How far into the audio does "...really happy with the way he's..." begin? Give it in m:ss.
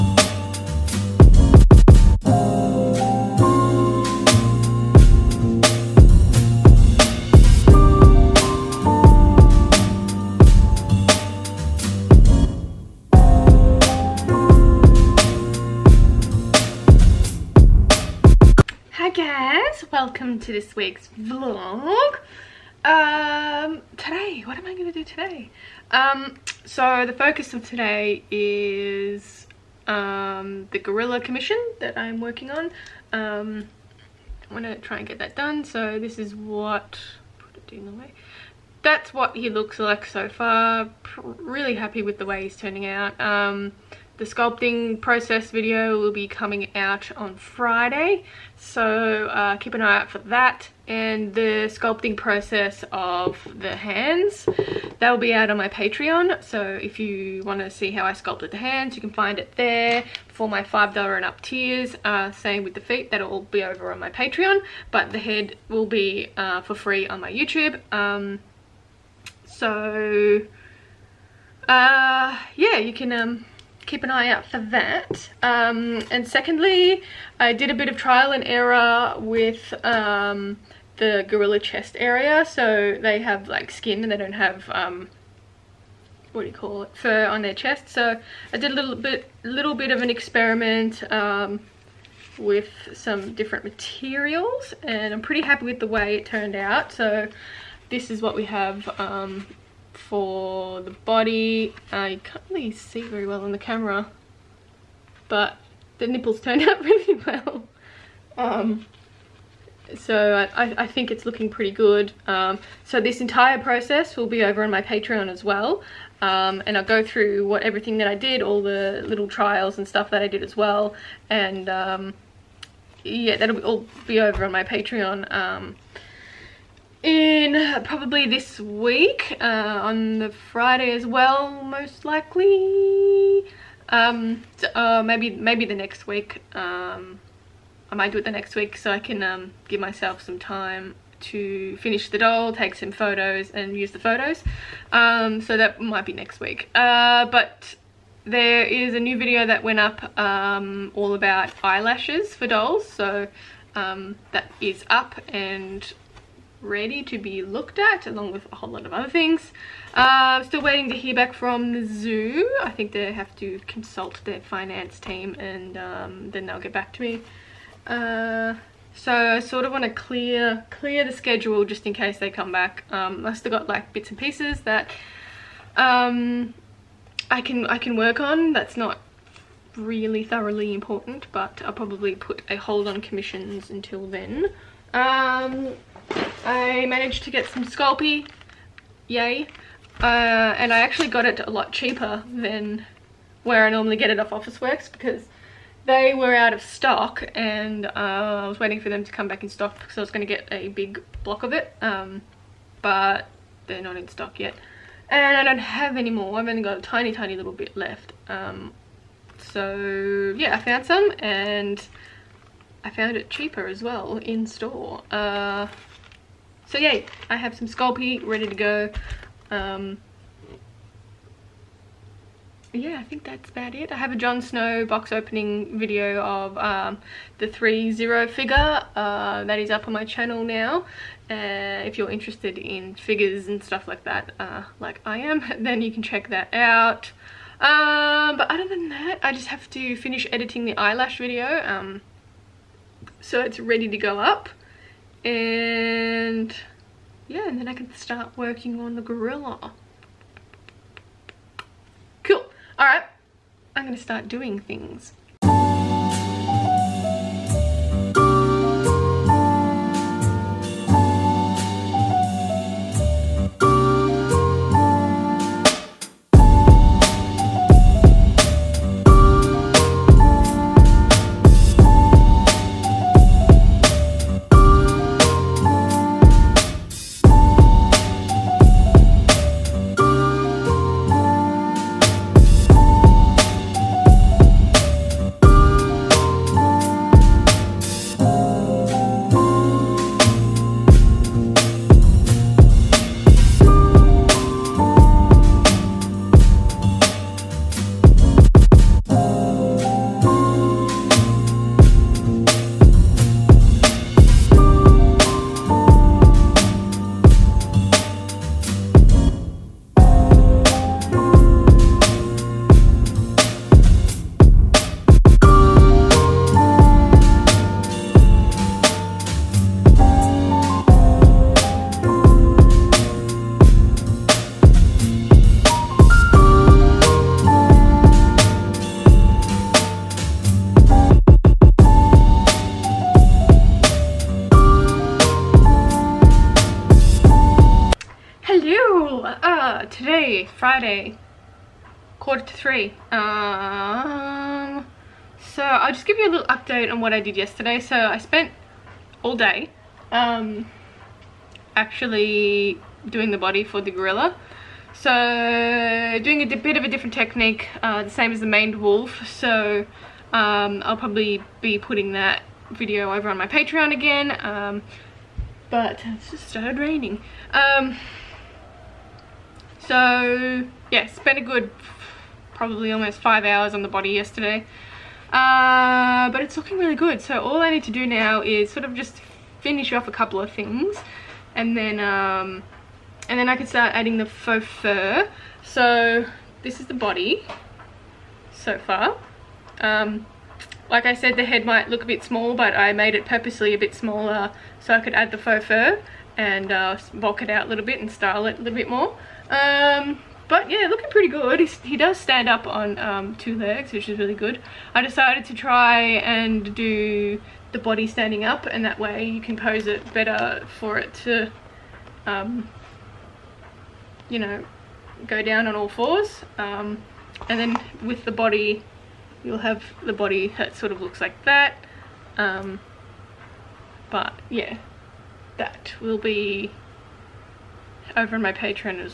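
0:41.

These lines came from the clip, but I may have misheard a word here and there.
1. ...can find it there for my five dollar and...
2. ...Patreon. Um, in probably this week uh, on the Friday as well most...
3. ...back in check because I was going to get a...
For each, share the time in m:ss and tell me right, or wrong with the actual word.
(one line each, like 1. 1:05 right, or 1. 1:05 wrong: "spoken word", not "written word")
1. 0:59 right
2. 2:04 right
3. 3:19 wrong: "stock", not "check".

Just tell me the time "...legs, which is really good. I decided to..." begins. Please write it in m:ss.
6:43.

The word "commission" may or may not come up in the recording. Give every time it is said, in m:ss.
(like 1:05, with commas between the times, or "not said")
0:31, 3:02.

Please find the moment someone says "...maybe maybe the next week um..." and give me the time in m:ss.
2:15.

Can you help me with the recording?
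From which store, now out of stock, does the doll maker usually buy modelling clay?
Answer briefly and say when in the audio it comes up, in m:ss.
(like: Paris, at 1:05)
Officeworks, at 3:14.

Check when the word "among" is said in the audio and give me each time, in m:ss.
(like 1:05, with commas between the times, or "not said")
not said.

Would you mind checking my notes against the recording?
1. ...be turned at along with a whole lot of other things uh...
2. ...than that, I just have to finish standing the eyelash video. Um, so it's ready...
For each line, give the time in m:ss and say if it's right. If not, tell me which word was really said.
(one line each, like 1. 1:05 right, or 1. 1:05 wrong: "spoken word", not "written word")
1. 2:37 wrong: "looked", not "turned"
2. 3:58 wrong: "editing", not "standing".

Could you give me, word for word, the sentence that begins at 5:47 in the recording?
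So I spent all day um, actually doing the body for the gorilla.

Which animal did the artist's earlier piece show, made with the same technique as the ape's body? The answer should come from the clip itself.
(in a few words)
maned wolf.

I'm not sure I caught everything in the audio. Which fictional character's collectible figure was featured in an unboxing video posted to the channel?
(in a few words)
Jon Snow.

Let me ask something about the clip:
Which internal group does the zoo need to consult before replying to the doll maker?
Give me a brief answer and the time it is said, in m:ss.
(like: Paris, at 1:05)
finance team, at 2:44.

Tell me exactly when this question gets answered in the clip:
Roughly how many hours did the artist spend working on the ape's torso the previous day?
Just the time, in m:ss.
6:13.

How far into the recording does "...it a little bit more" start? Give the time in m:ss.
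6:38.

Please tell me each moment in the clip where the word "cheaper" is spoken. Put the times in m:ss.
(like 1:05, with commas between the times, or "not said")
3:11, 3:33.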